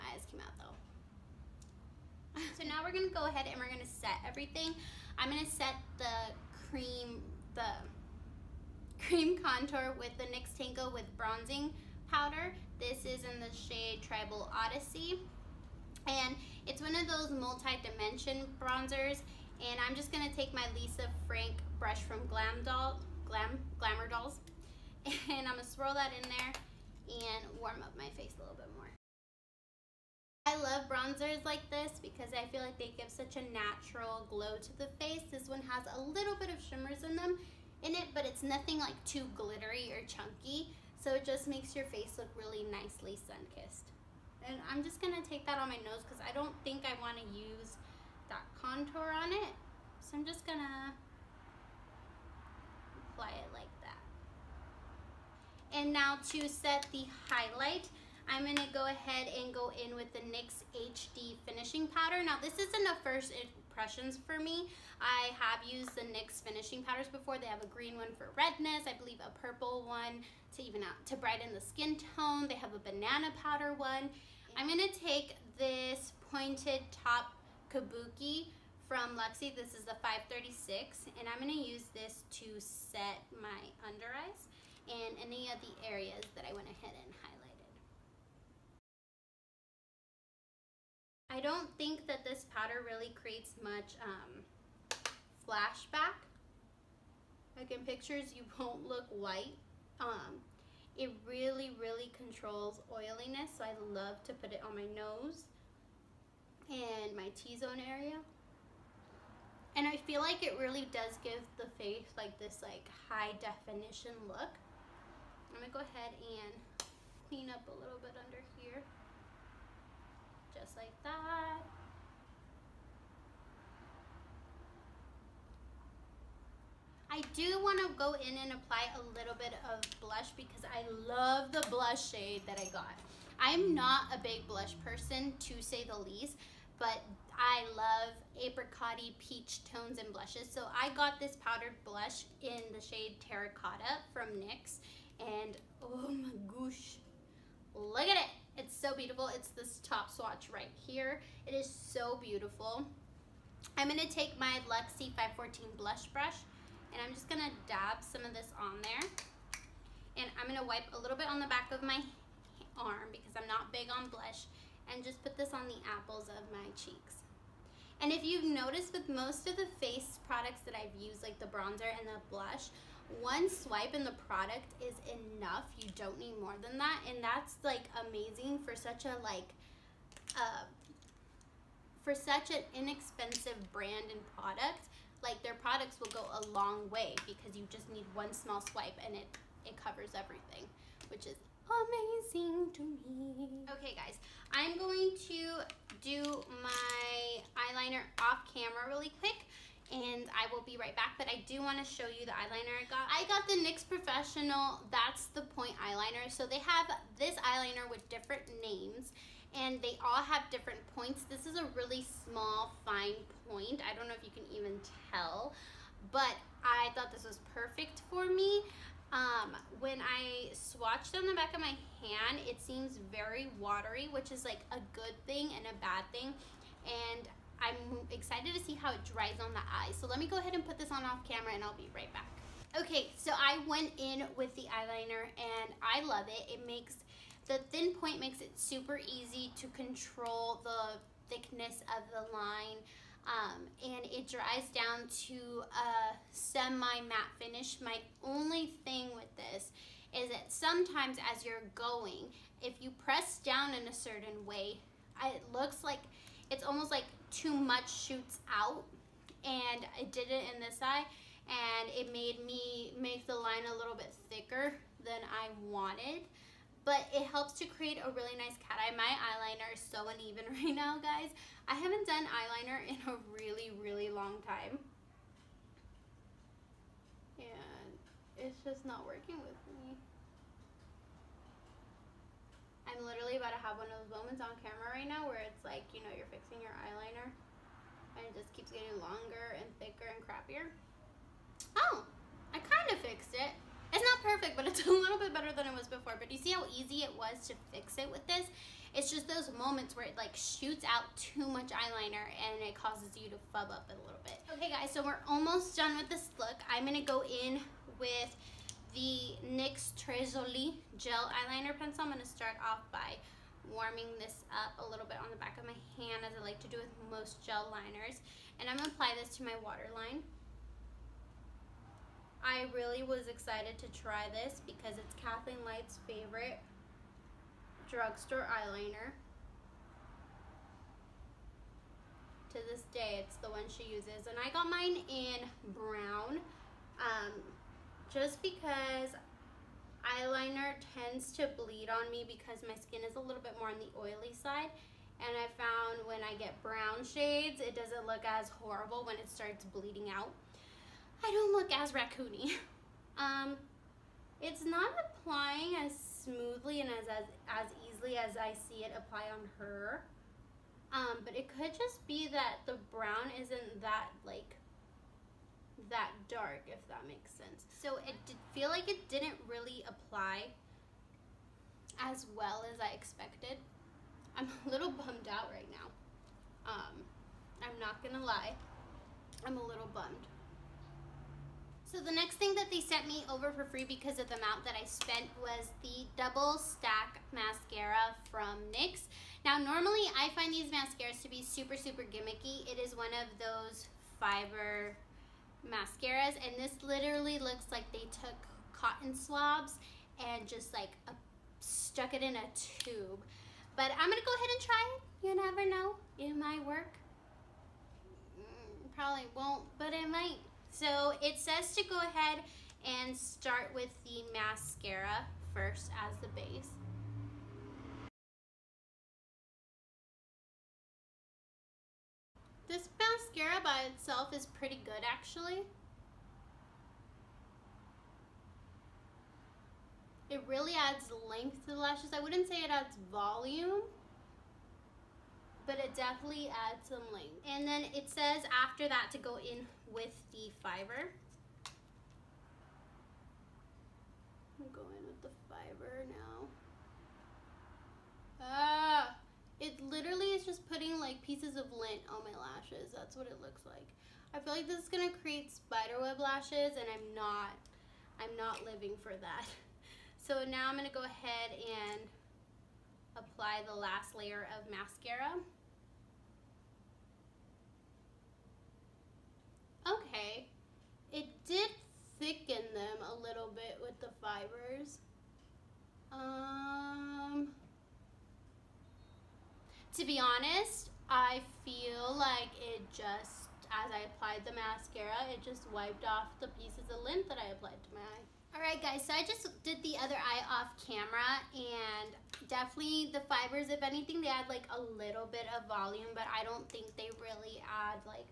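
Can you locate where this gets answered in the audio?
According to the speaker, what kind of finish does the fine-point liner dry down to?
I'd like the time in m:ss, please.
4:06.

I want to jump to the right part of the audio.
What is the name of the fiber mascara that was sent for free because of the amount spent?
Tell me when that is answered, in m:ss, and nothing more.
6:26.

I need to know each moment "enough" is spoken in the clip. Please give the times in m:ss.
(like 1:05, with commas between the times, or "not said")
2:55.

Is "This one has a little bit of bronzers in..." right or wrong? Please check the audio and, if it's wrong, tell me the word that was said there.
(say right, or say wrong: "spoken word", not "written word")
wrong: "shimmers", not "bronzers".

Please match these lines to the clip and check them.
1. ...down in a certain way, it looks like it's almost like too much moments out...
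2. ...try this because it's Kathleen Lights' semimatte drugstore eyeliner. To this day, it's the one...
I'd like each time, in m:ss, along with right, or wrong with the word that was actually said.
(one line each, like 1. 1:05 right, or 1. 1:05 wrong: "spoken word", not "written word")
1. 4:13 wrong: "shoots", not "moments"
2. 5:24 wrong: "favorite", not "semimatte".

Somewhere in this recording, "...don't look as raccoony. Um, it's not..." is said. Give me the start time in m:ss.
5:51.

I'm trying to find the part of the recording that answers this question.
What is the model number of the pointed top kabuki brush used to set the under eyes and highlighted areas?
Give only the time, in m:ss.
1:20.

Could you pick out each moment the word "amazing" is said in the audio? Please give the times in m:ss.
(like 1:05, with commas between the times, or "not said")
2:58, 3:11.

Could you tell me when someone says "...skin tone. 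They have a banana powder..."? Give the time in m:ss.
1:11.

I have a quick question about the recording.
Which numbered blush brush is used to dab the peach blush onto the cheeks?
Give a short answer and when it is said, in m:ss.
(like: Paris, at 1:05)
Luxie 514, at 2:34.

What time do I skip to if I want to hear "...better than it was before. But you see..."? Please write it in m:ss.
4:55.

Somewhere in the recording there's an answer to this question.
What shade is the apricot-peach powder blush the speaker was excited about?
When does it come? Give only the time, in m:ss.
2:23.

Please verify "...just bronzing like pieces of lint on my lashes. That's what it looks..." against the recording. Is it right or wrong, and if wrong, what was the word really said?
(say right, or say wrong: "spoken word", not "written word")
wrong: "putting", not "bronzing".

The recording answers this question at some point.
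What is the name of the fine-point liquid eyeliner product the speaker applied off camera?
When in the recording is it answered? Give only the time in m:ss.
3:24.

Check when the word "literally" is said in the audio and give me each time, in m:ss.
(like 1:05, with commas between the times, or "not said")
4:43, 6:36, 7:29.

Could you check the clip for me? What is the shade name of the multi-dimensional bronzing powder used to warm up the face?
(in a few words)
Tribal Odyssey.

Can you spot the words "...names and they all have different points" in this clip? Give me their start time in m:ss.
3:28.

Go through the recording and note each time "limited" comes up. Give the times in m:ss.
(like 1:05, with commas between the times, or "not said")
not said.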